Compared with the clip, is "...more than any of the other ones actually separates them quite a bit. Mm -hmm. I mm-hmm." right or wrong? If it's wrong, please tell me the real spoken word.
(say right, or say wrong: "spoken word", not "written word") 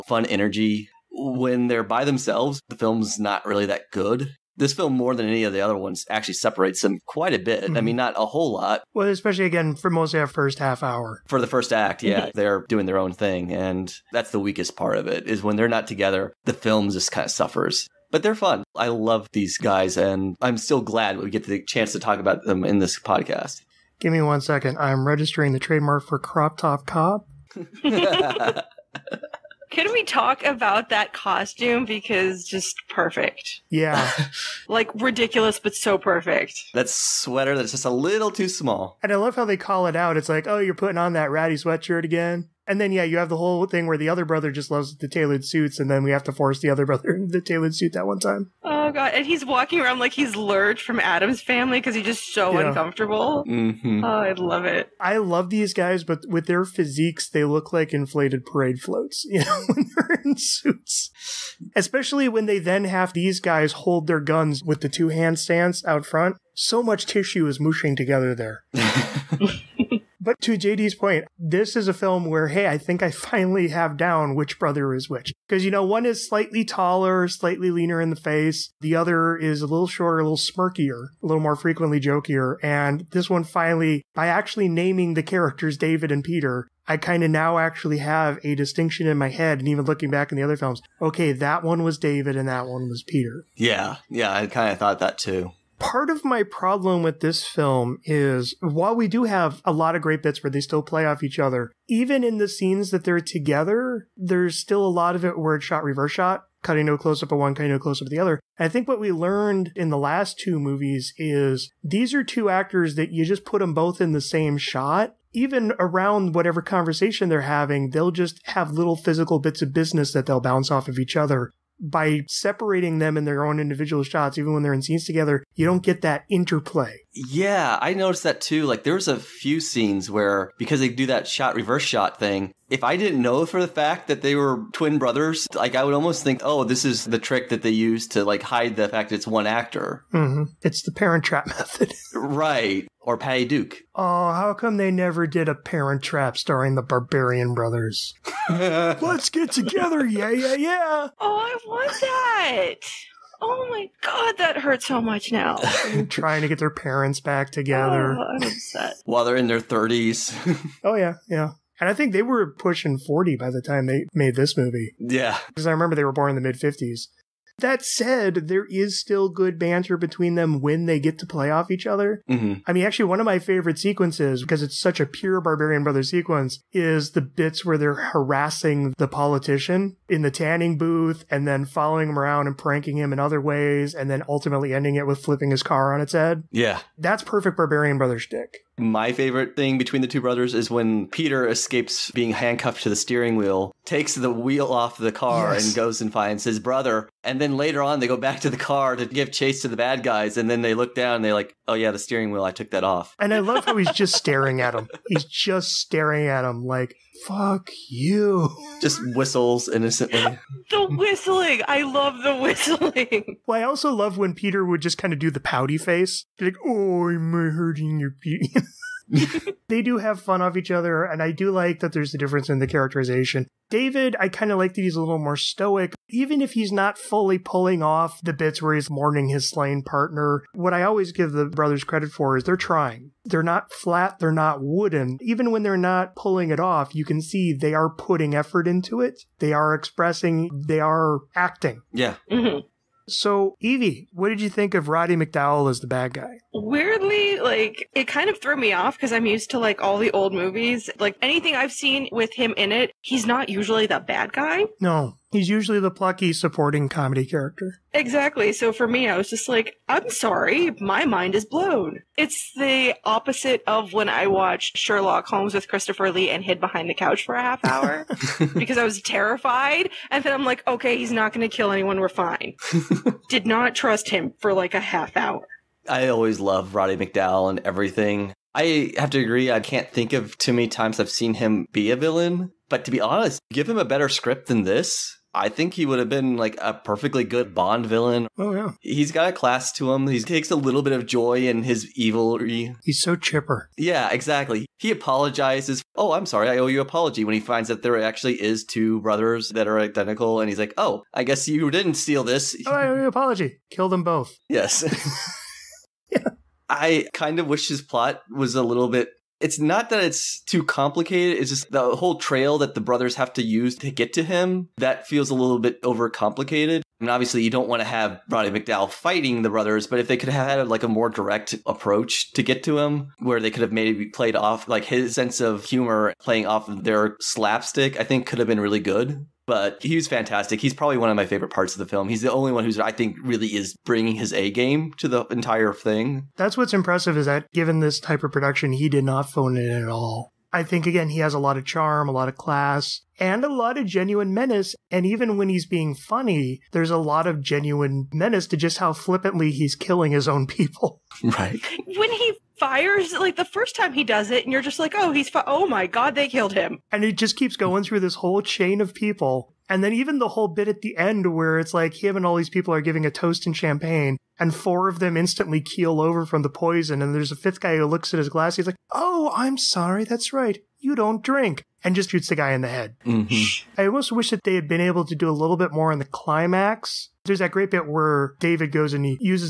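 right.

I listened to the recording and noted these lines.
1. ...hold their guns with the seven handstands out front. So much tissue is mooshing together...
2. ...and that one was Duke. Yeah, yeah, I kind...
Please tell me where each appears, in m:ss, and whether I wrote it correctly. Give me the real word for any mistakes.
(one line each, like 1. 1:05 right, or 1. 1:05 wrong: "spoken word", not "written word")
1. 1:03 wrong: "two", not "seven"
2. 1:32 wrong: "Peter", not "Duke".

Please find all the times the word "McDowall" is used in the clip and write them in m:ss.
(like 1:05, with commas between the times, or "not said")
4:05, 4:36, 5:18.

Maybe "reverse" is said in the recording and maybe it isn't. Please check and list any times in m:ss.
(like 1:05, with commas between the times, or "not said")
1:45, 2:11.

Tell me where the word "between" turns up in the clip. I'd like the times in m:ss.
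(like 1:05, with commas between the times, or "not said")
2:49, 3:09.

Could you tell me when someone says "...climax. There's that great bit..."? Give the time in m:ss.
6:16.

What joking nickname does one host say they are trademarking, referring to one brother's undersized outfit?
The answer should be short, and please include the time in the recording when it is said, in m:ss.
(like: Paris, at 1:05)
Crop Top Cop, at 0:26.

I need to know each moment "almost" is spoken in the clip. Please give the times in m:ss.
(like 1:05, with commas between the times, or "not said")
2:15, 6:13.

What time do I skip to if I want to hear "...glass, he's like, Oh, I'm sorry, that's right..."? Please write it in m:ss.
6:08.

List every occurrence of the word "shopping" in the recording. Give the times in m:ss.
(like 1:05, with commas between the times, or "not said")
not said.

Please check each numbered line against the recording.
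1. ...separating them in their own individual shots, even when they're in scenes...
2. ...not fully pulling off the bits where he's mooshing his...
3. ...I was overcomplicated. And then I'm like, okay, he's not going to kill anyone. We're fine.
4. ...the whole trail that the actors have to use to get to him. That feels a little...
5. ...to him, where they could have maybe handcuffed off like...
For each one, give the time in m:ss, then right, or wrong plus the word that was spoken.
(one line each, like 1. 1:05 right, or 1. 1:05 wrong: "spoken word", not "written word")
1. 2:02 right
2. 3:46 wrong: "mourning", not "mooshing"
3. 4:28 wrong: "terrified", not "overcomplicated"
4. 5:11 wrong: "brothers", not "actors"
5. 5:22 wrong: "played", not "handcuffed".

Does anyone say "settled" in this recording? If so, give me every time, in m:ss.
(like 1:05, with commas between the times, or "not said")
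not said.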